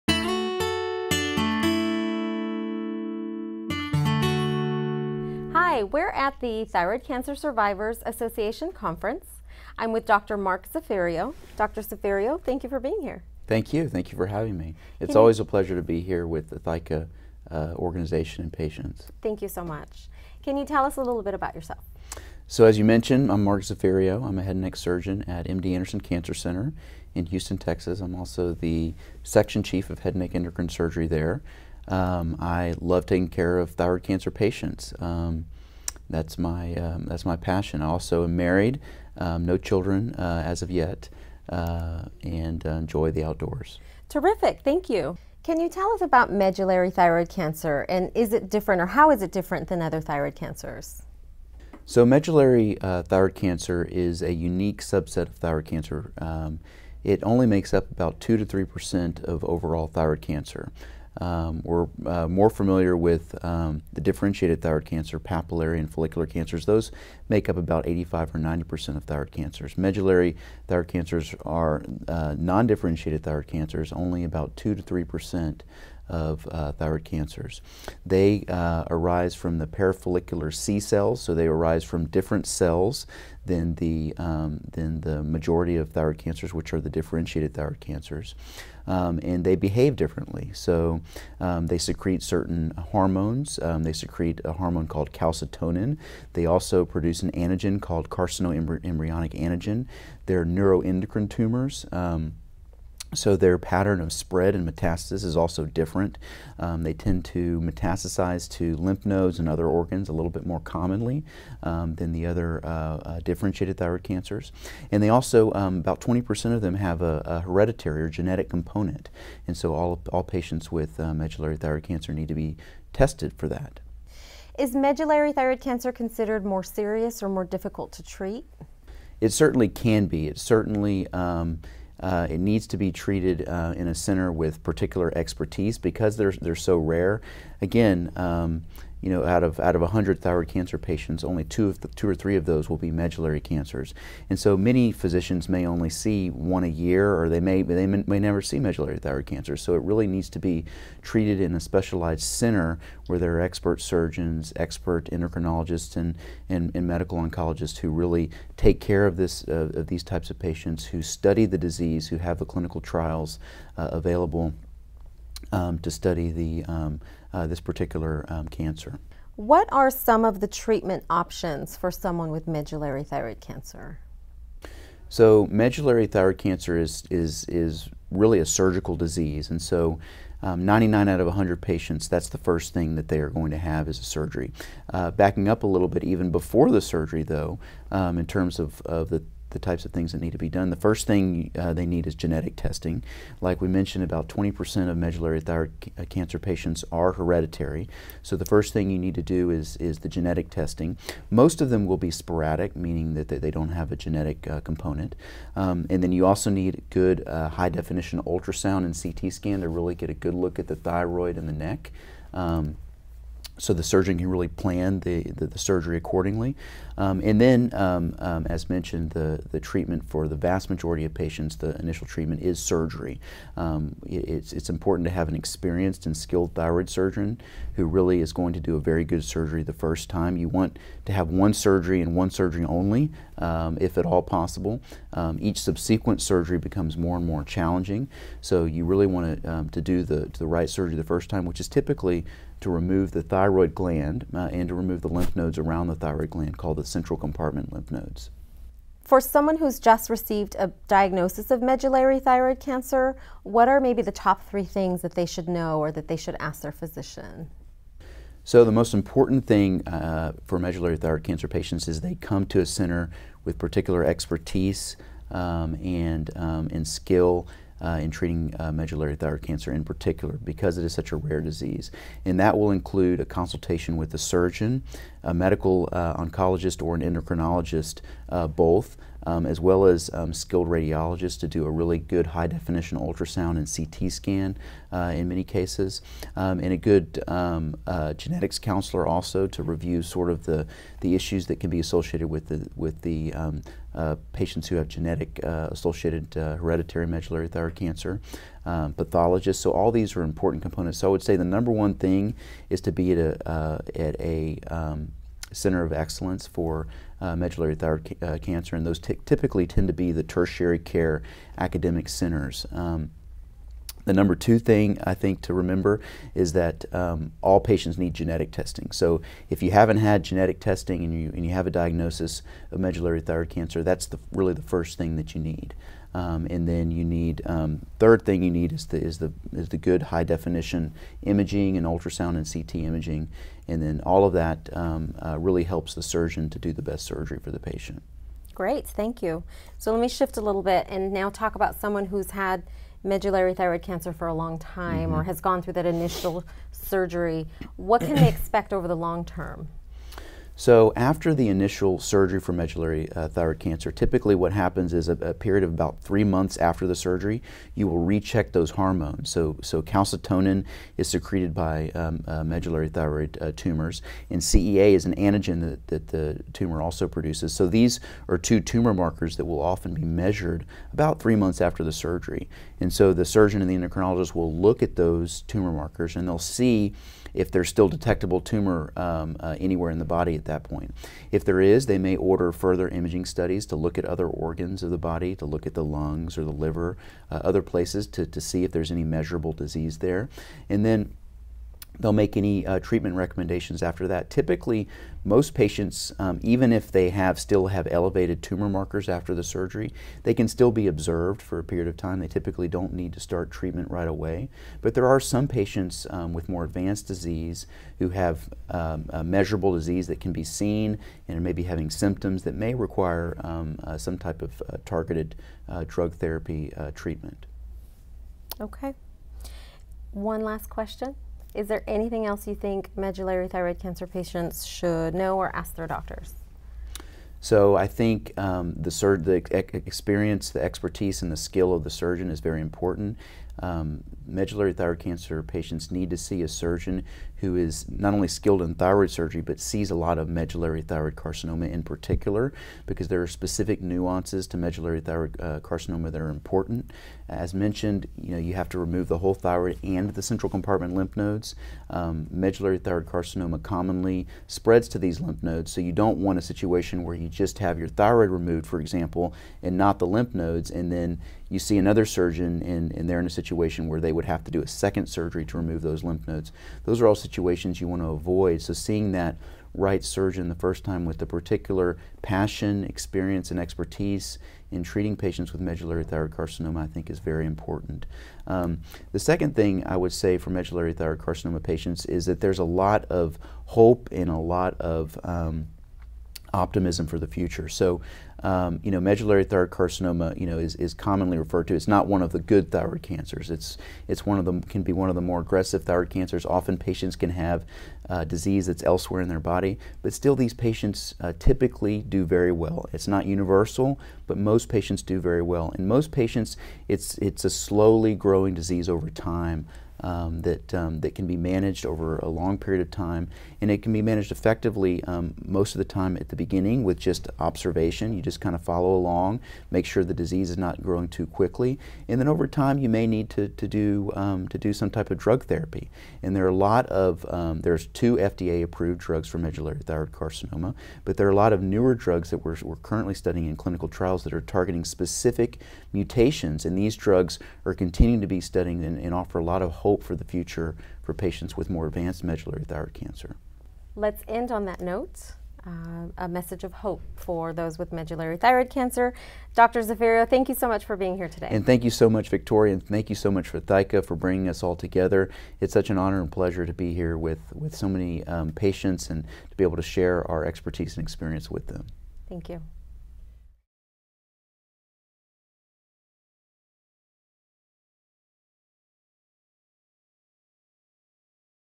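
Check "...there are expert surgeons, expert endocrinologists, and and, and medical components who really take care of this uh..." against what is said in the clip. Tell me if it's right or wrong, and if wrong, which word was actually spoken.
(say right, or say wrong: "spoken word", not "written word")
wrong: "oncologists", not "components".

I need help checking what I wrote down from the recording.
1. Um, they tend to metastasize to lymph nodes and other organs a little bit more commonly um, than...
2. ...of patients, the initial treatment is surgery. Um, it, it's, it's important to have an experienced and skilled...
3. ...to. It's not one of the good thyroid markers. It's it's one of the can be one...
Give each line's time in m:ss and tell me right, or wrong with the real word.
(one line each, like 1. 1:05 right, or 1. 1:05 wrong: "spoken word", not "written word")
1. 1:46 right
2. 3:41 right
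3. 8:11 wrong: "cancers", not "markers".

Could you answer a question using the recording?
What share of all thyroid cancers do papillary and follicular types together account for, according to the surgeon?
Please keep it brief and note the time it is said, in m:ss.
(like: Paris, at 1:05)
85 or 90 percent, at 1:07.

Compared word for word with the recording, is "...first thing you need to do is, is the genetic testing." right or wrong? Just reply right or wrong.
right.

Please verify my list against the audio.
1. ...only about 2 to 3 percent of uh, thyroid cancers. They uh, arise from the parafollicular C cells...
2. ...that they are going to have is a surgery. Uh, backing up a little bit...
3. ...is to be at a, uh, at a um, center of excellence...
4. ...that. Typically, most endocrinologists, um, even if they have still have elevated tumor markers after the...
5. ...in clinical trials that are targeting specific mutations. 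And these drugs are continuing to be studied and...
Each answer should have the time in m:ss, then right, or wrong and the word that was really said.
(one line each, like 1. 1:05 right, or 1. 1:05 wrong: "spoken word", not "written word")
1. 1:13 right
2. 3:02 right
3. 5:02 right
4. 6:34 wrong: "patients", not "endocrinologists"
5. 8:53 right.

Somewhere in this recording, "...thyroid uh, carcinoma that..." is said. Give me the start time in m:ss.
7:25.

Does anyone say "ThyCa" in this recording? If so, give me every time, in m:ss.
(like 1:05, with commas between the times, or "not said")
0:16, 9:13.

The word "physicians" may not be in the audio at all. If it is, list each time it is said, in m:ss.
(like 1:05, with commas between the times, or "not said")
2:24, 4:16.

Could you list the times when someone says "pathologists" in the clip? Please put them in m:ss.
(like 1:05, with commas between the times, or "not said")
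4:58.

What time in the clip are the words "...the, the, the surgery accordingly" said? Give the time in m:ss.
3:35.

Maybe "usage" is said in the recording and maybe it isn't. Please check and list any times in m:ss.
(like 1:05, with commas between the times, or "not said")
not said.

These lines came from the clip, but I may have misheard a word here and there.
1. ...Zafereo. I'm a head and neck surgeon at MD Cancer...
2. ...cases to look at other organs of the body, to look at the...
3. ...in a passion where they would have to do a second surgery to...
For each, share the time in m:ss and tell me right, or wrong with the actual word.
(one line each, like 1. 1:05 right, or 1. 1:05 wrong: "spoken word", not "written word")
1. 0:23 wrong: "Anderson", not "Cancer"
2. 6:23 wrong: "studies", not "cases"
3. 7:43 wrong: "situation", not "passion".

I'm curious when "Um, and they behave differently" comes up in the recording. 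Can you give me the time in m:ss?
1:28.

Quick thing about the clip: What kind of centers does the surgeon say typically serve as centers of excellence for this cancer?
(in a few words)
tertiary care academic centers.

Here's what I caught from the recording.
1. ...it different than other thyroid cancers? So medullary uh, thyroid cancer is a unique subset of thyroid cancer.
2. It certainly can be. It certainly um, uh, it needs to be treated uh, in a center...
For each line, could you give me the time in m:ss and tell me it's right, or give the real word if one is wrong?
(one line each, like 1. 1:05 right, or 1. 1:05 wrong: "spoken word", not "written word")
1. 0:49 right
2. 2:09 right.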